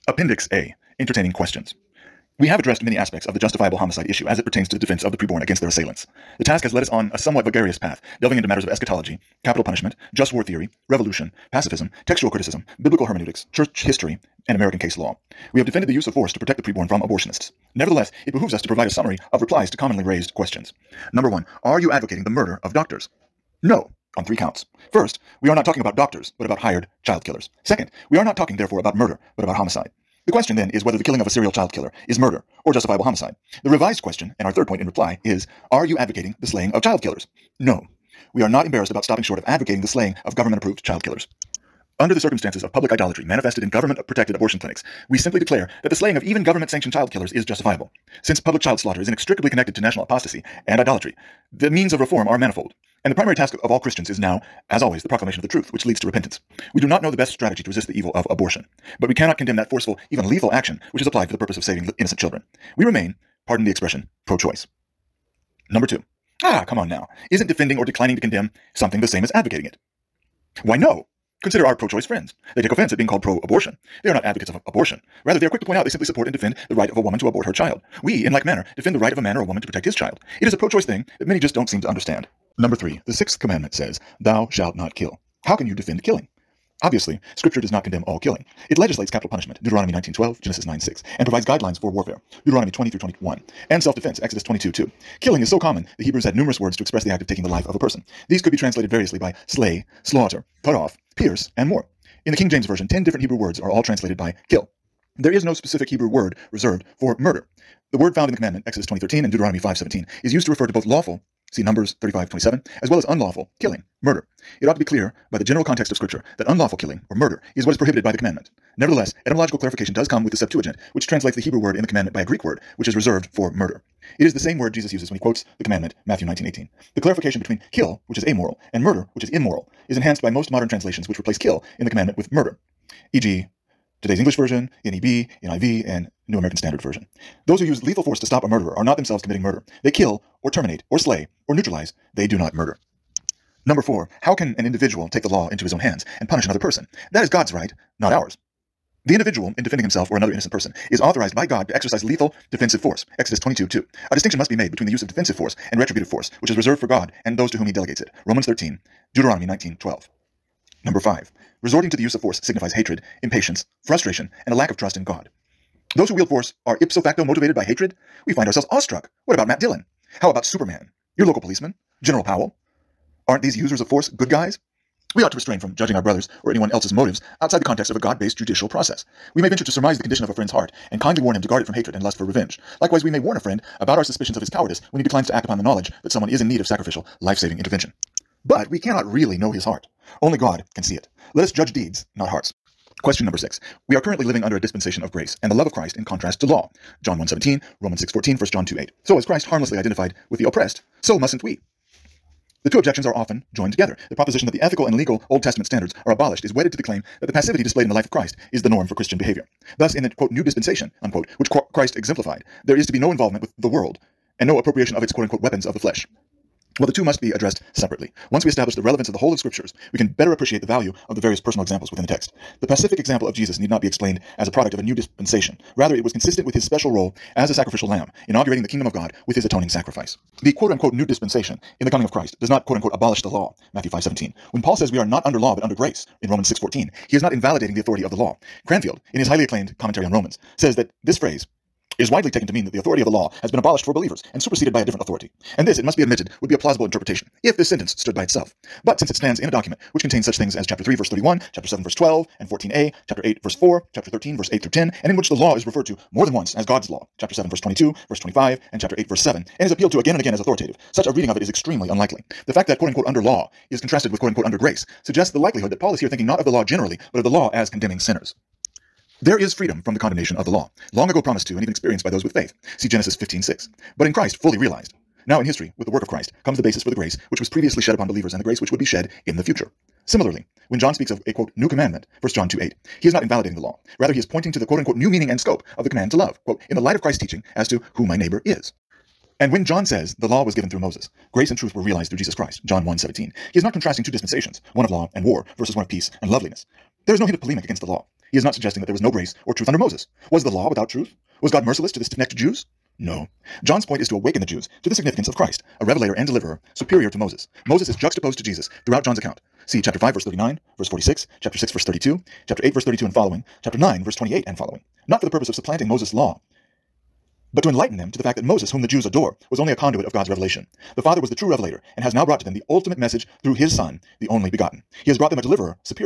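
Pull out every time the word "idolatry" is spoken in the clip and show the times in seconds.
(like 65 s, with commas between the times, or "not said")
42 s, 50 s.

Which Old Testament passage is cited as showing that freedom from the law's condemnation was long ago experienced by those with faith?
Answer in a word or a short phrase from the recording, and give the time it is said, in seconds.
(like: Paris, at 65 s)
Genesis 15:6, at 272 s.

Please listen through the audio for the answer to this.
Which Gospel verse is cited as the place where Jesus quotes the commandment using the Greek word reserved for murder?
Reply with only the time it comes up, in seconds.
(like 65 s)
126 s.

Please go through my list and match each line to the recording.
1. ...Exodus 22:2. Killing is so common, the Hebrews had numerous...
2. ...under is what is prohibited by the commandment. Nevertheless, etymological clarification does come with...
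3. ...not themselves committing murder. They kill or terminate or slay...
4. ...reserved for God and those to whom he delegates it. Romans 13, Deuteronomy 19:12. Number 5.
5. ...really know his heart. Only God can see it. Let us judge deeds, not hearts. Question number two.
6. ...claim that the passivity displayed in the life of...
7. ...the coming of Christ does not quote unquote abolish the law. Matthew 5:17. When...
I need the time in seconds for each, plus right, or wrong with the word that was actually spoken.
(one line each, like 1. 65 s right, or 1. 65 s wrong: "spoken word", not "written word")
1. 94 s right
2. 117 s wrong: "murder", not "under"
3. 138 s right
4. 156 s right
5. 189 s wrong: "six", not "two"
6. 206 s right
7. 231 s right.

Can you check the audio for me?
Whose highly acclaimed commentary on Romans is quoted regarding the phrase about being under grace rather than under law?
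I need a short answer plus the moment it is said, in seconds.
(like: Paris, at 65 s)
Cranfield, at 238 s.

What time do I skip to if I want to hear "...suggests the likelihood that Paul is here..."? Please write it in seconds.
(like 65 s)
265 s.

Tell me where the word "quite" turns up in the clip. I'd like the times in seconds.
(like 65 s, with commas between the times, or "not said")
not said.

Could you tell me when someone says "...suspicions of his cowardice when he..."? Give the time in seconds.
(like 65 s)
184 s.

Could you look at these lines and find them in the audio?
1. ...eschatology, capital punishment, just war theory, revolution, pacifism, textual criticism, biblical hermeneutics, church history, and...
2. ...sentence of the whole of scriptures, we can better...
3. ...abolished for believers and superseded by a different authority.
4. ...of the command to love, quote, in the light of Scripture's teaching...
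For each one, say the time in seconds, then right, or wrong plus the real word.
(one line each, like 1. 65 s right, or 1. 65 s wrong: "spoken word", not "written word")
1. 8 s right
2. 218 s wrong: "relevance", not "sentence"
3. 243 s right
4. 285 s wrong: "Christ", not "Scripture".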